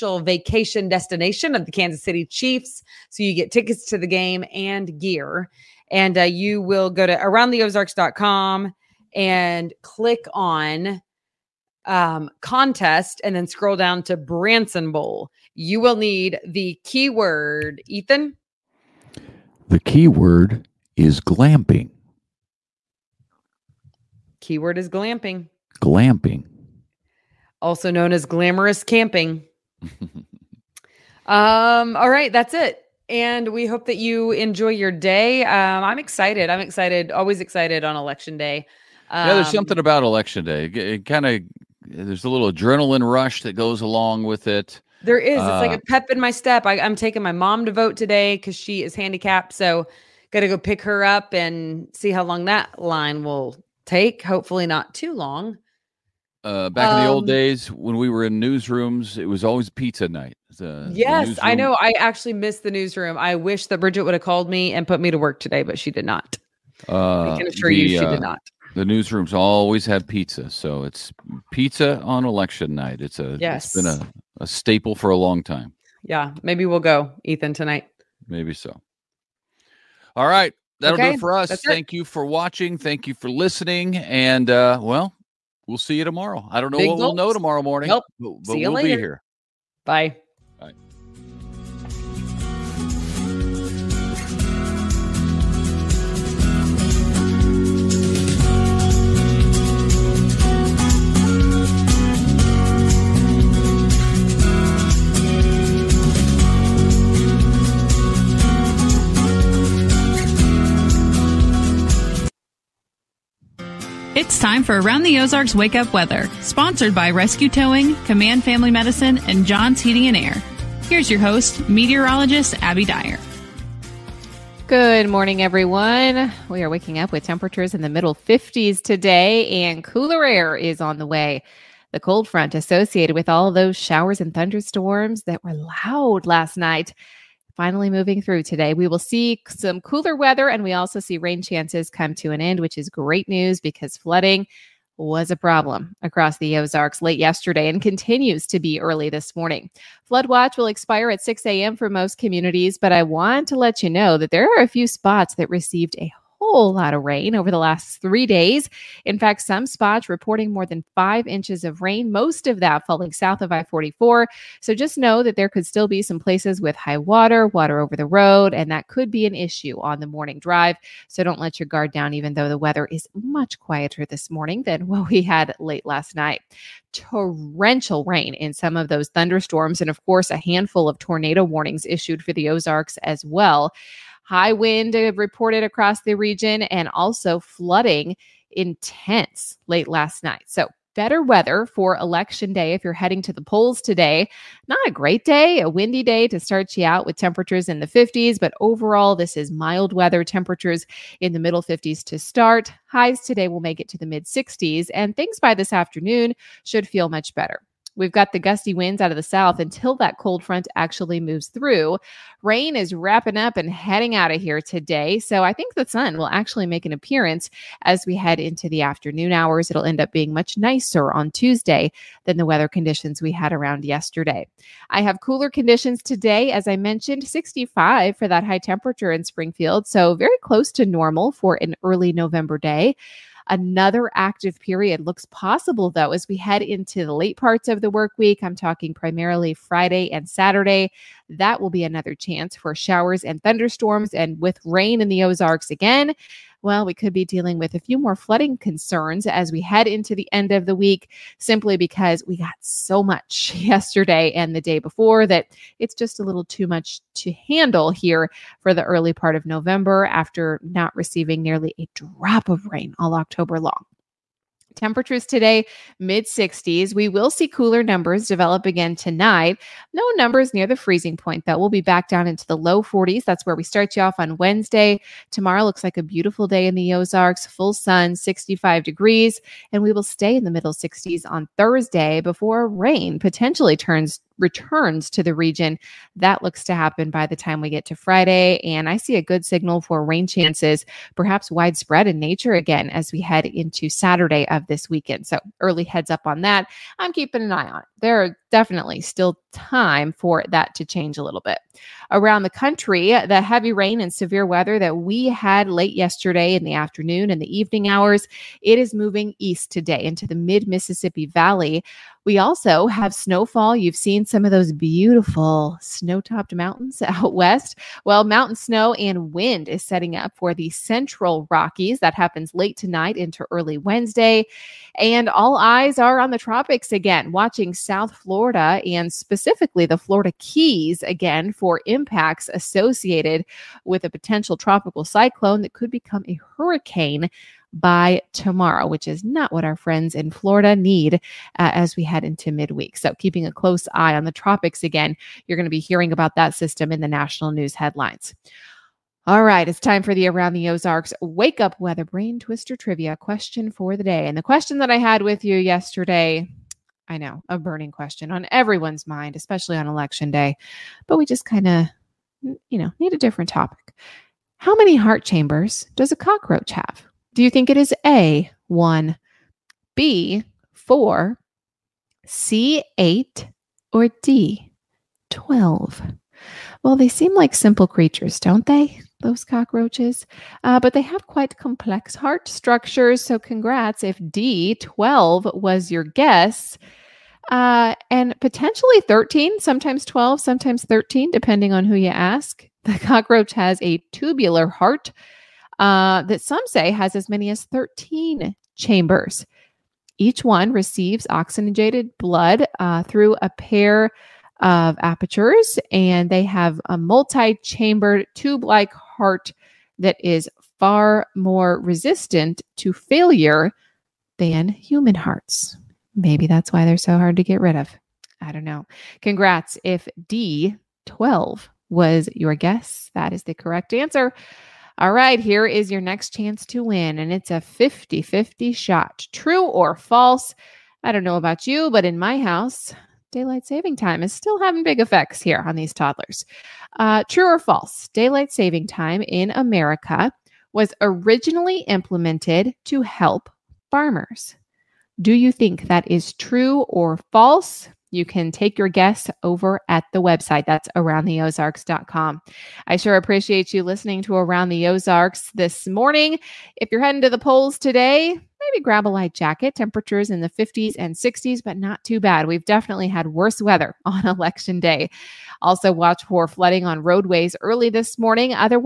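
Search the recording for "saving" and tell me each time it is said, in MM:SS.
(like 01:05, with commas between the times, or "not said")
07:13, 07:18.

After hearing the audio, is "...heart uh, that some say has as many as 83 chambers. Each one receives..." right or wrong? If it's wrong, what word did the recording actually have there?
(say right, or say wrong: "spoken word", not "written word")
wrong: "13", not "83".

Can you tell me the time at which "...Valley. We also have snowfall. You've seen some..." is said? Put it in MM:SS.
05:11.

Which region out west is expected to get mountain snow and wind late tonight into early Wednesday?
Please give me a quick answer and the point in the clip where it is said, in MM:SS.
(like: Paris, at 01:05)
central Rockies, at 05:20.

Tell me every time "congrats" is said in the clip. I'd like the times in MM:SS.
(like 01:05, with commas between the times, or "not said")
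06:23, 06:59.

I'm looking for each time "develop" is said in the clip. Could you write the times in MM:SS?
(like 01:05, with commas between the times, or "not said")
04:28.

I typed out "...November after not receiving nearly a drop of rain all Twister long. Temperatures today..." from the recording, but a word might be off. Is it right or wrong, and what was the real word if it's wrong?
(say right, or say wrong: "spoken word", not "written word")
wrong: "October", not "Twister".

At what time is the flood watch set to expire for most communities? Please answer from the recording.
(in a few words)
6 a.m.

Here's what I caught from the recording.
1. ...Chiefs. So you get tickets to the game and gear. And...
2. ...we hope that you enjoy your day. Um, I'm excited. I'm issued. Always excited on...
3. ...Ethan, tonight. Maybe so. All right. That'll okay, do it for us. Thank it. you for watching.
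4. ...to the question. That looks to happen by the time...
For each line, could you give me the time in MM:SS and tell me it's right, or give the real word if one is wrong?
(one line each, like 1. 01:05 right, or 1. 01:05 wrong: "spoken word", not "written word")
1. 00:02 right
2. 00:33 wrong: "excited", not "issued"
3. 01:17 right
4. 04:45 wrong: "region", not "question".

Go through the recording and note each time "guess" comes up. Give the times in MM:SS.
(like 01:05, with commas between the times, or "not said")
06:26, 07:02, 07:28.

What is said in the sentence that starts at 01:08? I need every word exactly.
The newsrooms always have pizza, so it's pizza on election night.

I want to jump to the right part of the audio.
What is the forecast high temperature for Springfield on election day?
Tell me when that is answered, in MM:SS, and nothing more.
03:47.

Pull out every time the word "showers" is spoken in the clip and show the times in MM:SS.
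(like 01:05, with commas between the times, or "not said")
02:13, 04:02.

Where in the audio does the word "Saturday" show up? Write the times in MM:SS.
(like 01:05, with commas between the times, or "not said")
04:00, 04:53.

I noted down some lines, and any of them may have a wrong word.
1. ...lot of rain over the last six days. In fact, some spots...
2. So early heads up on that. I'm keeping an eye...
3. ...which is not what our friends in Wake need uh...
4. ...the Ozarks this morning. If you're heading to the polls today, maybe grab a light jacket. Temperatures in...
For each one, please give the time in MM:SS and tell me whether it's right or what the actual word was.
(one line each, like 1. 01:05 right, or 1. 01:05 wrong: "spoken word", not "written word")
1. 02:36 wrong: "three", not "six"
2. 04:55 right
3. 05:38 wrong: "Florida", not "Wake"
4. 07:34 right.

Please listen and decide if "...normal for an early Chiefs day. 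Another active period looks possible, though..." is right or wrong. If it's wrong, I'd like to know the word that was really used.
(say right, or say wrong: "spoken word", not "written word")
wrong: "November", not "Chiefs".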